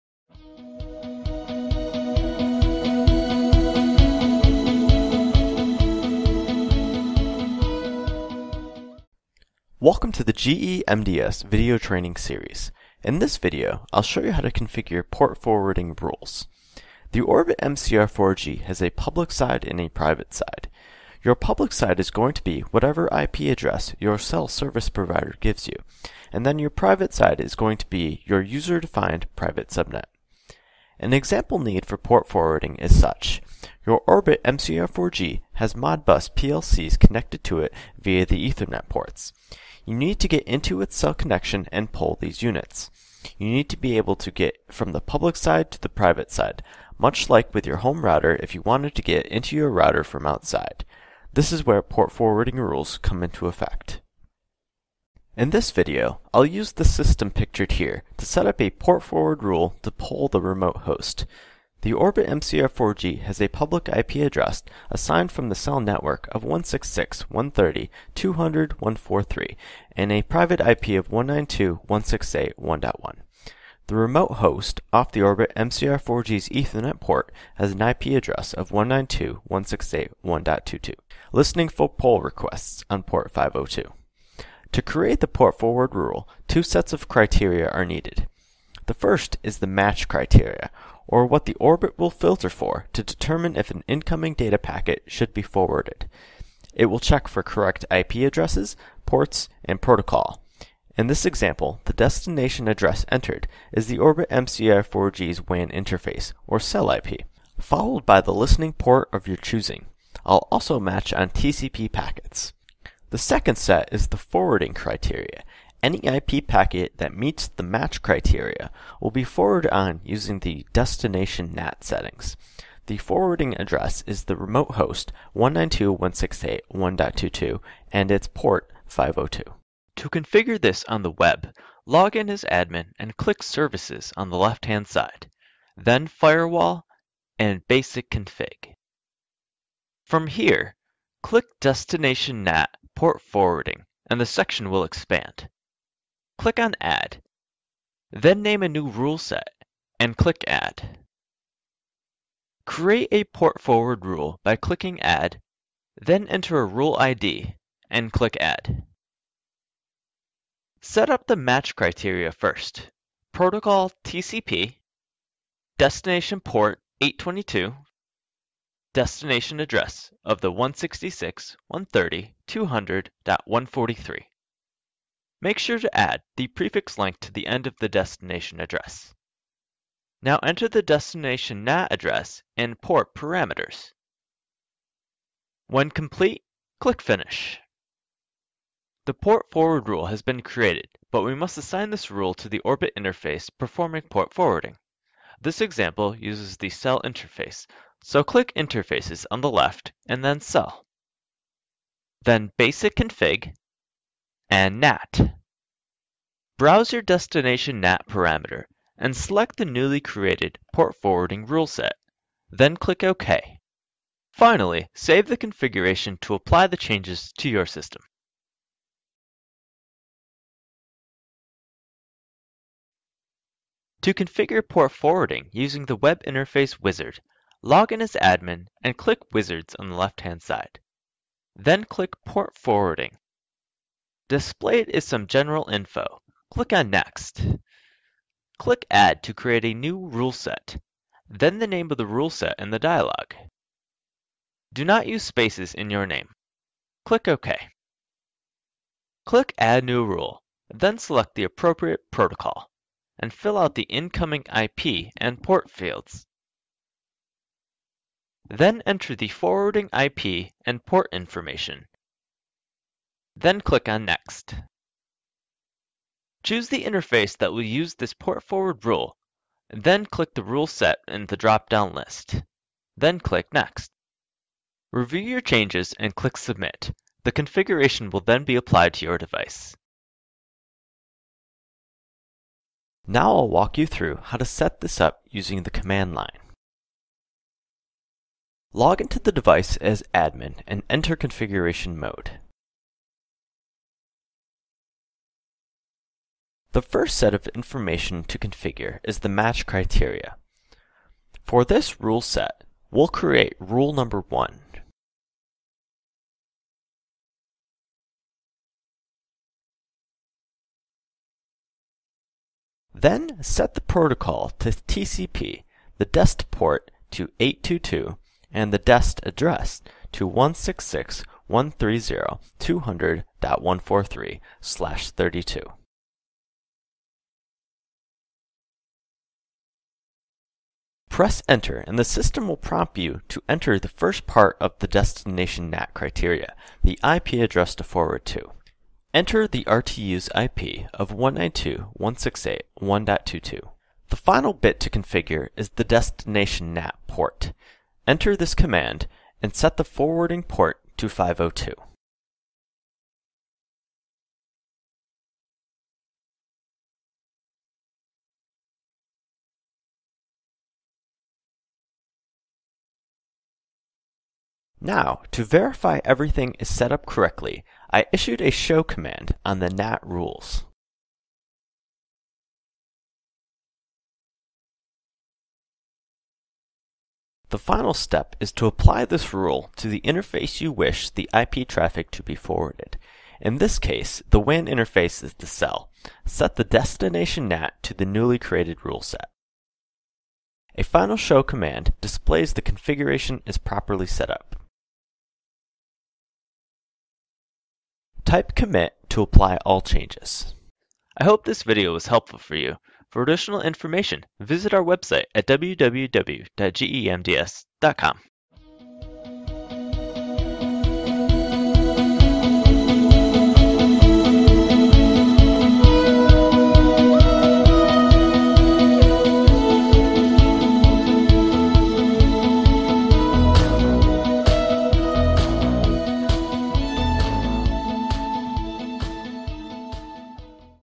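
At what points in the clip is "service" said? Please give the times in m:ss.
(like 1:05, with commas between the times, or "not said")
0:24, 2:13.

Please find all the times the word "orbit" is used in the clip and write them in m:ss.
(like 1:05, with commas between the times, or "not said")
0:17, 0:34, 1:01, 1:15, 1:31, 1:43, 3:12.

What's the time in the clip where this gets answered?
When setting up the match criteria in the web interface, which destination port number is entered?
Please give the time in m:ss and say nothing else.
2:45.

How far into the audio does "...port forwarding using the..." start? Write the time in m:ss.
3:44.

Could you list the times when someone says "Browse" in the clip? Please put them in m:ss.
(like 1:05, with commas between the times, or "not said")
3:26.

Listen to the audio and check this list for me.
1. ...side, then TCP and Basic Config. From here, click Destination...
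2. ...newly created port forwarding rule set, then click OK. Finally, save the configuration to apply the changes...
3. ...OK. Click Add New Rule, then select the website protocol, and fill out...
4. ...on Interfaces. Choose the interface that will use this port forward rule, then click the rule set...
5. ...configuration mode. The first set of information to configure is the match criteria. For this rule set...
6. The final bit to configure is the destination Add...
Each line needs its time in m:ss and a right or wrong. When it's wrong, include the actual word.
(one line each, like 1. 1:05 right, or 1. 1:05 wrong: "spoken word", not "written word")
1. 2:14 wrong: "Firewall", not "TCP"
2. 3:29 right
3. 4:07 wrong: "appropriate", not "website"
4. 4:23 wrong: "Next", not "Interfaces"
5. 4:51 right
6. 5:44 wrong: "NAT", not "Add".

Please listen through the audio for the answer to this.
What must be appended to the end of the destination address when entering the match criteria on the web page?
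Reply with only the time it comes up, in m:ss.
2:56.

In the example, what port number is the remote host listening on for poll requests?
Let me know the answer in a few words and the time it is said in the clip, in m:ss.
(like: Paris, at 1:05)
502, at 1:21.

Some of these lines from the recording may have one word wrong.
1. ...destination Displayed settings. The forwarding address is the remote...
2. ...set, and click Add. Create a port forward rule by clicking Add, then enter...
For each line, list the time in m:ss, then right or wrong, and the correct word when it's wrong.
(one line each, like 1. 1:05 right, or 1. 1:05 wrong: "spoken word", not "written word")
1. 2:00 wrong: "NAT", not "Displayed"
2. 2:29 right.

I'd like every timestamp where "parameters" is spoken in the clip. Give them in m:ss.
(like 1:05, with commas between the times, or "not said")
3:03, 3:28.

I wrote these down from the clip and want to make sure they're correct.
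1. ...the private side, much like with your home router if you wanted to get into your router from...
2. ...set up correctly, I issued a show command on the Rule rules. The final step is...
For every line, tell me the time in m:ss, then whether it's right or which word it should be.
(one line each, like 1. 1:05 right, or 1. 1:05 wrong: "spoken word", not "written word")
1. 0:45 right
2. 6:06 wrong: "NAT", not "Rule".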